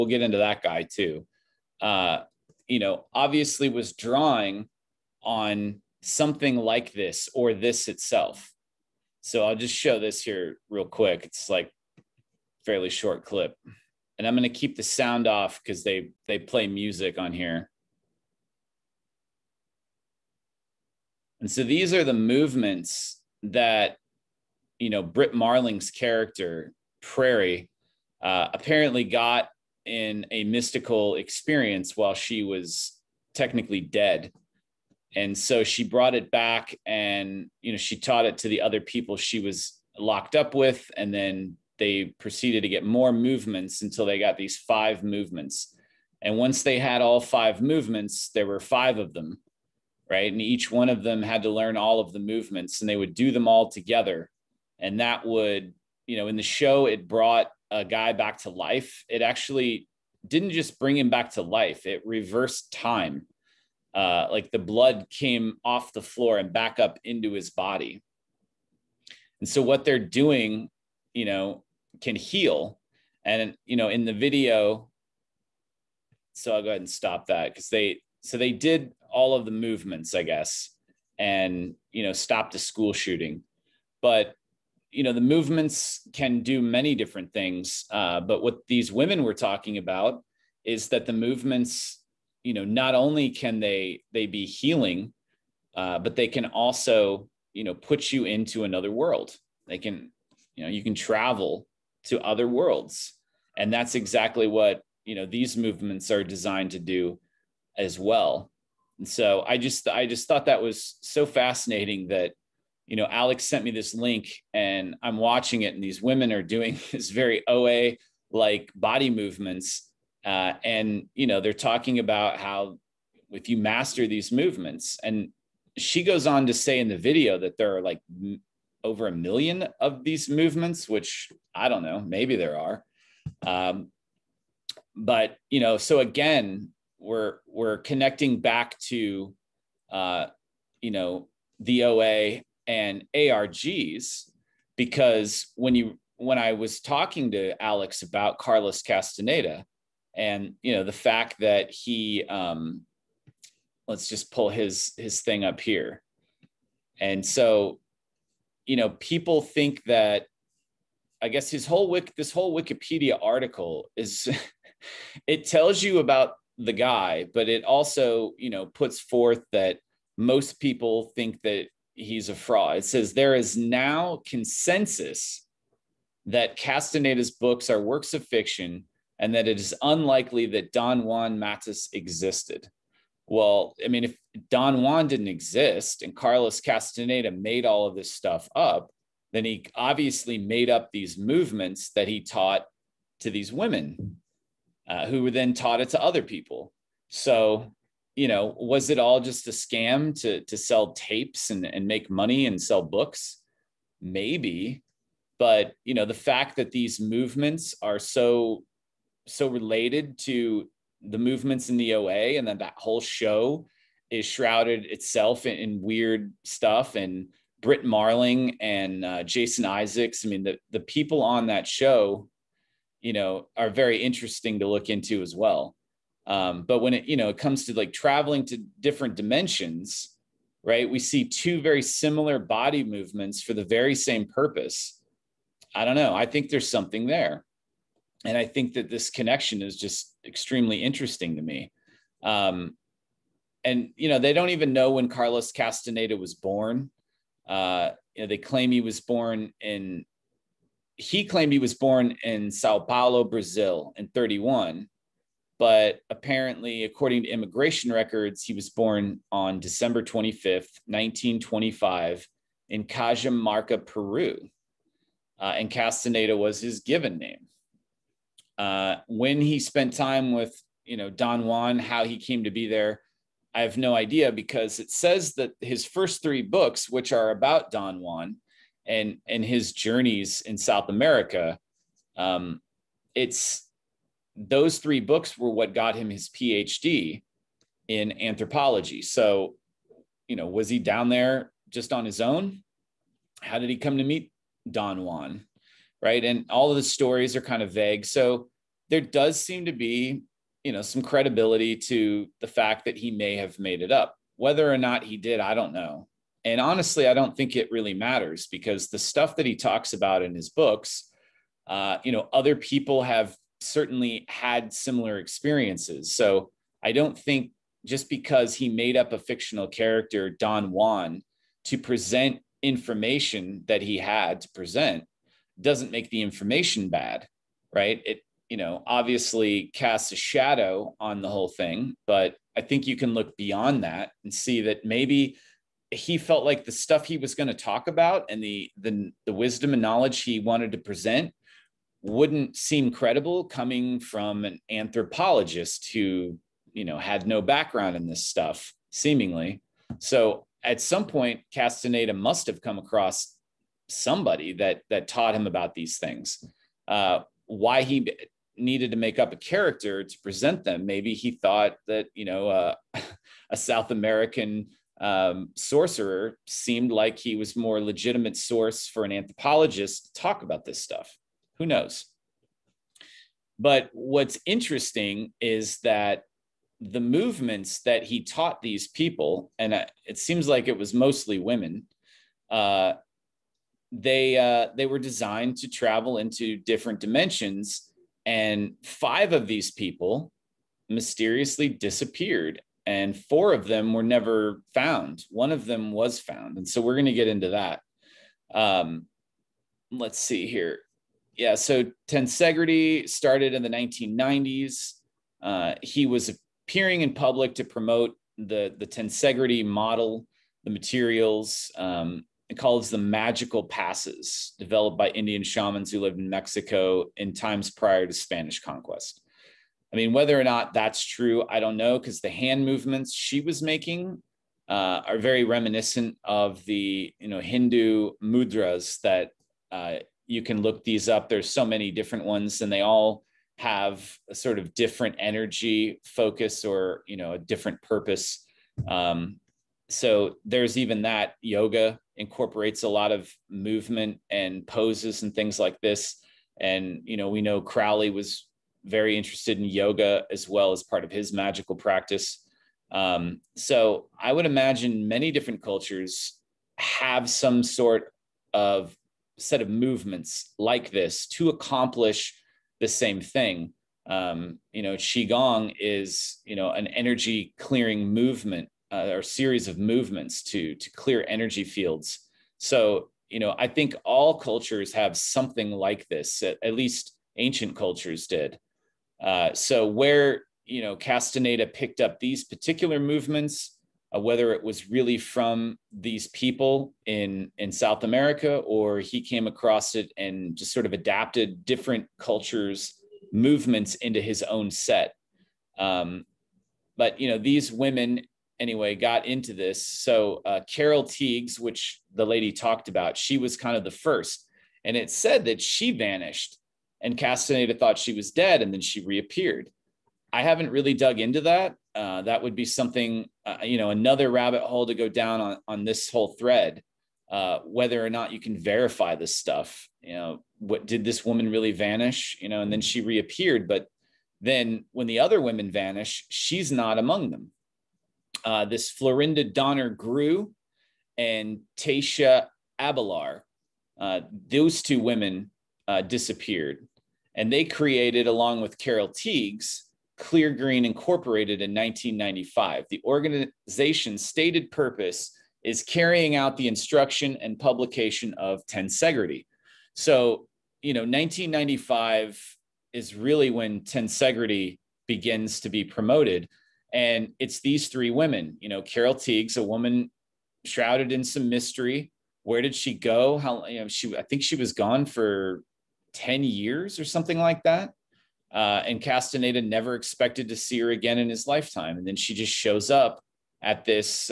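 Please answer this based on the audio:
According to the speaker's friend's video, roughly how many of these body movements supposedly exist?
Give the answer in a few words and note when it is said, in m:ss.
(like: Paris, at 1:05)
over a million, at 2:08.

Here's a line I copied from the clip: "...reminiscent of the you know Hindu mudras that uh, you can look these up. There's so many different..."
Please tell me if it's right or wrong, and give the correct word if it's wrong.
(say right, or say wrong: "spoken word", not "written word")
right.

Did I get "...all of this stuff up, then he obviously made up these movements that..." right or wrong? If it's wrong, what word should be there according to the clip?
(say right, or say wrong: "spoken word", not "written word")
right.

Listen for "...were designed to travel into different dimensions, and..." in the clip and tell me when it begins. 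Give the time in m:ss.
6:24.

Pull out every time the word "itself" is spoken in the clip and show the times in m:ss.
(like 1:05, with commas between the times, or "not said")
0:07, 3:34.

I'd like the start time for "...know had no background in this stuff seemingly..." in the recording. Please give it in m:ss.
5:46.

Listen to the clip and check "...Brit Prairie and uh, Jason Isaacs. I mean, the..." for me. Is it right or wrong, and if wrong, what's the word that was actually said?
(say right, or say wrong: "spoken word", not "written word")
wrong: "Marling", not "Prairie".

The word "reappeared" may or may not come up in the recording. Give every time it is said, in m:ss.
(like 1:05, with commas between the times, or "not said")
8:29, 8:43.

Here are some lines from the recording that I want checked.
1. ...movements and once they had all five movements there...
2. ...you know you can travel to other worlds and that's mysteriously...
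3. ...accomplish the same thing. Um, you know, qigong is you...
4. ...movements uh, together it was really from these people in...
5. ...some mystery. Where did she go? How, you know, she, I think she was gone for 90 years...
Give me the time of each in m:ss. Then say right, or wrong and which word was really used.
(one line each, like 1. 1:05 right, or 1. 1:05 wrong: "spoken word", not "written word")
1. 0:45 right
2. 1:40 wrong: "exactly", not "mysteriously"
3. 7:41 right
4. 8:02 wrong: "whether", not "together"
5. 9:21 wrong: "10", not "90".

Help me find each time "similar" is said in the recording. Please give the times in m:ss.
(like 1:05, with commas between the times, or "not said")
3:51, 5:14.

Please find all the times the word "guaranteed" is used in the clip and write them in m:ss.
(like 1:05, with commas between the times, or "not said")
not said.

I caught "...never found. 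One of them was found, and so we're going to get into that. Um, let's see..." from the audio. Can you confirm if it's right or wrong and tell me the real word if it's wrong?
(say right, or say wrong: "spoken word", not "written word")
right.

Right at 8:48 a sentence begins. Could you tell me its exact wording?
Uh, this Florinda Donner Grau and Taisha Abelar, uh, those two women uh, disappeared.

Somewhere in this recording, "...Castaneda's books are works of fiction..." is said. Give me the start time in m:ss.
2:56.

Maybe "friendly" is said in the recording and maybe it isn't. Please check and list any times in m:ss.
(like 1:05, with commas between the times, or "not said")
not said.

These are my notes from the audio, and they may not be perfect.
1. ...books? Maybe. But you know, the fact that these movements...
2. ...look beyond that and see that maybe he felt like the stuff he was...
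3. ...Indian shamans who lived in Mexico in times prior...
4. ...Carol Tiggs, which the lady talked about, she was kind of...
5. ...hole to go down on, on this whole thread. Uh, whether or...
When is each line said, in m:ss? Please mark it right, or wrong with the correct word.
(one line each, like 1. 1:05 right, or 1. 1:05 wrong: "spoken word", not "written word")
1. 3:22 right
2. 5:33 right
3. 6:55 right
4. 8:20 right
5. 8:34 right.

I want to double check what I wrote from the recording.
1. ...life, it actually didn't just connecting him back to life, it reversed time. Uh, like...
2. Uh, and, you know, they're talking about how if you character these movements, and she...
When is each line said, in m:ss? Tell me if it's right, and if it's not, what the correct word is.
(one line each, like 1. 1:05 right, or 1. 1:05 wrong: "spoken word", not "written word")
1. 0:58 wrong: "bring", not "connecting"
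2. 2:00 wrong: "master", not "character".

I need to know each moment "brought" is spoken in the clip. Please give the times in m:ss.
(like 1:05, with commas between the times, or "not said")
0:35, 0:57.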